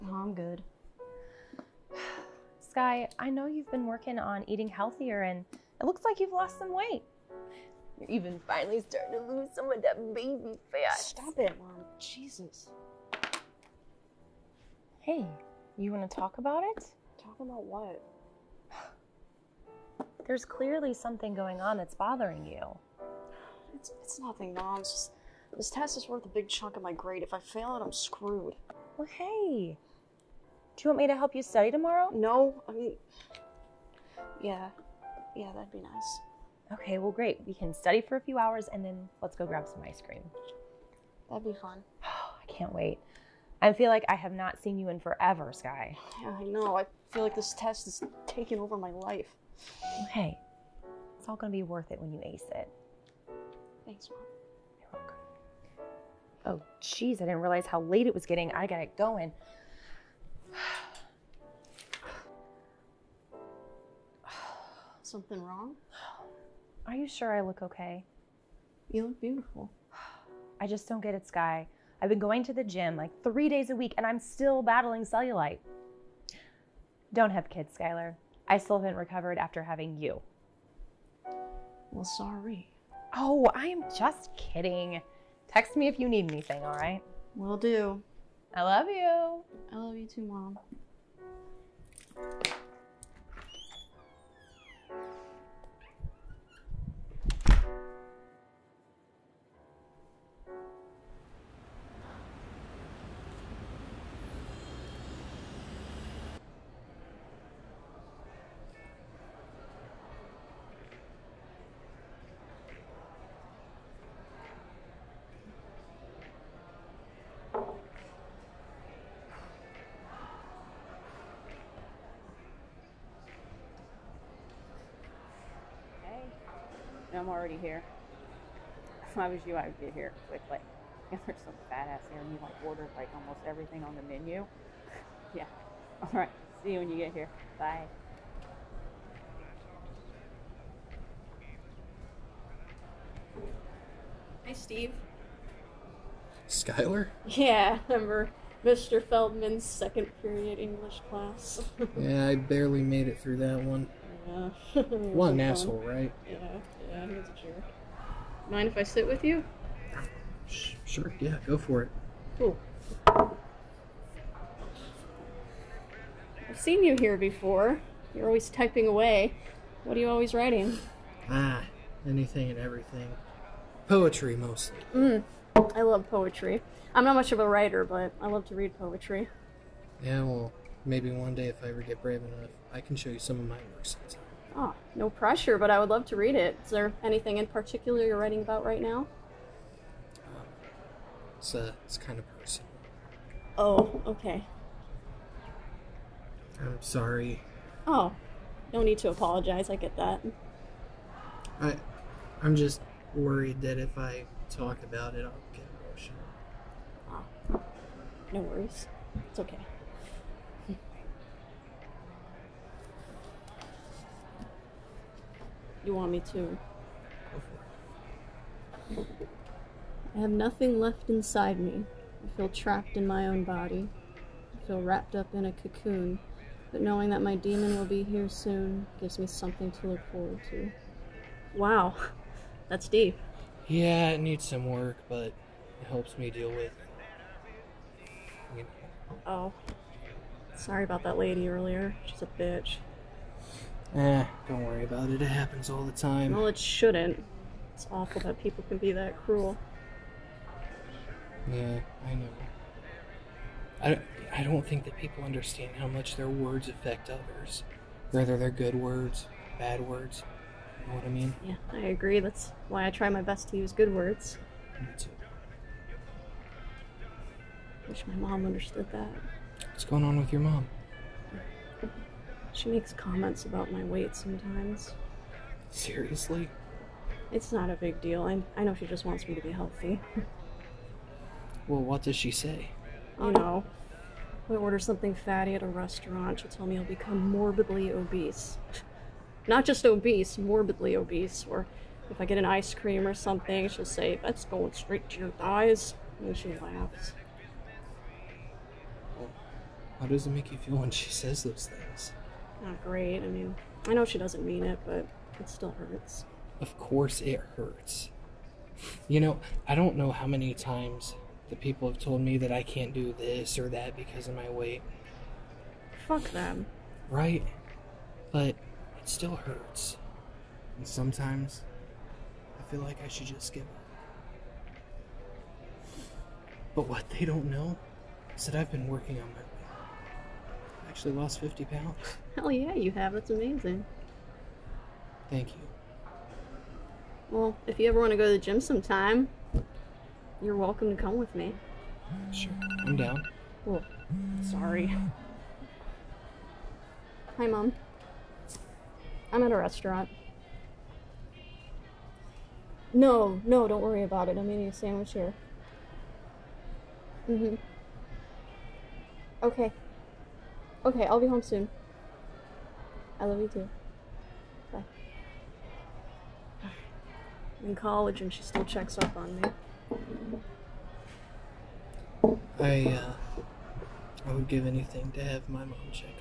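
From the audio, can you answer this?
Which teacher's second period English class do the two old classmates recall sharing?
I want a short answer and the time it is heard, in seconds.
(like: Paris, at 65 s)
Mr. Feldman, at 148 s.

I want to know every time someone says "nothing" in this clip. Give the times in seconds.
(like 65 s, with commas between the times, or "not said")
24 s, 220 s.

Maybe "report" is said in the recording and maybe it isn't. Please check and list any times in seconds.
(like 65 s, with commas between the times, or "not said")
not said.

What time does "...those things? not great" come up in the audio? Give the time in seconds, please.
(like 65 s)
301 s.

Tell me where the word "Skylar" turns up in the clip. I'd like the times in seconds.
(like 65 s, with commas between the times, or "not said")
77 s, 146 s.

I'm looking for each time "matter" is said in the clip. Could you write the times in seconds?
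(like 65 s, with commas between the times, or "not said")
not said.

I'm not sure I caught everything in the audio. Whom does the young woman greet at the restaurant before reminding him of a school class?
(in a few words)
Steve.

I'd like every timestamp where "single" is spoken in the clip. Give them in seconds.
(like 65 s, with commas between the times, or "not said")
not said.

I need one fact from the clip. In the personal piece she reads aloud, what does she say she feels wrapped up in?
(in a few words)
a cocoon.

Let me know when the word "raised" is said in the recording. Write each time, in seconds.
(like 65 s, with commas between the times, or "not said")
not said.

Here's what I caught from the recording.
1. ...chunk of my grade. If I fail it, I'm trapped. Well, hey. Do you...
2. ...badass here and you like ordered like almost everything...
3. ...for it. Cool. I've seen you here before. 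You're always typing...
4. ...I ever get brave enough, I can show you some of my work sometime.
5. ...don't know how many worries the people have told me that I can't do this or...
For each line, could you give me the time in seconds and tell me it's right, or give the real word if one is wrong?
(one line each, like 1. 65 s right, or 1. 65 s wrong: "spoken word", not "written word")
1. 26 s wrong: "screwed", not "trapped"
2. 131 s right
3. 161 s right
4. 181 s right
5. 309 s wrong: "times", not "worries".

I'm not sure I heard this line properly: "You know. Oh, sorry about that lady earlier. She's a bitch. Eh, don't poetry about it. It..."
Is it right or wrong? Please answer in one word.
wrong.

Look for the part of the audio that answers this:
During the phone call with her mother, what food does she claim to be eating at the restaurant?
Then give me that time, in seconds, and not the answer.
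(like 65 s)
354 s.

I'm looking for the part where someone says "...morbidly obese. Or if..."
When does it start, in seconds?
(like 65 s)
290 s.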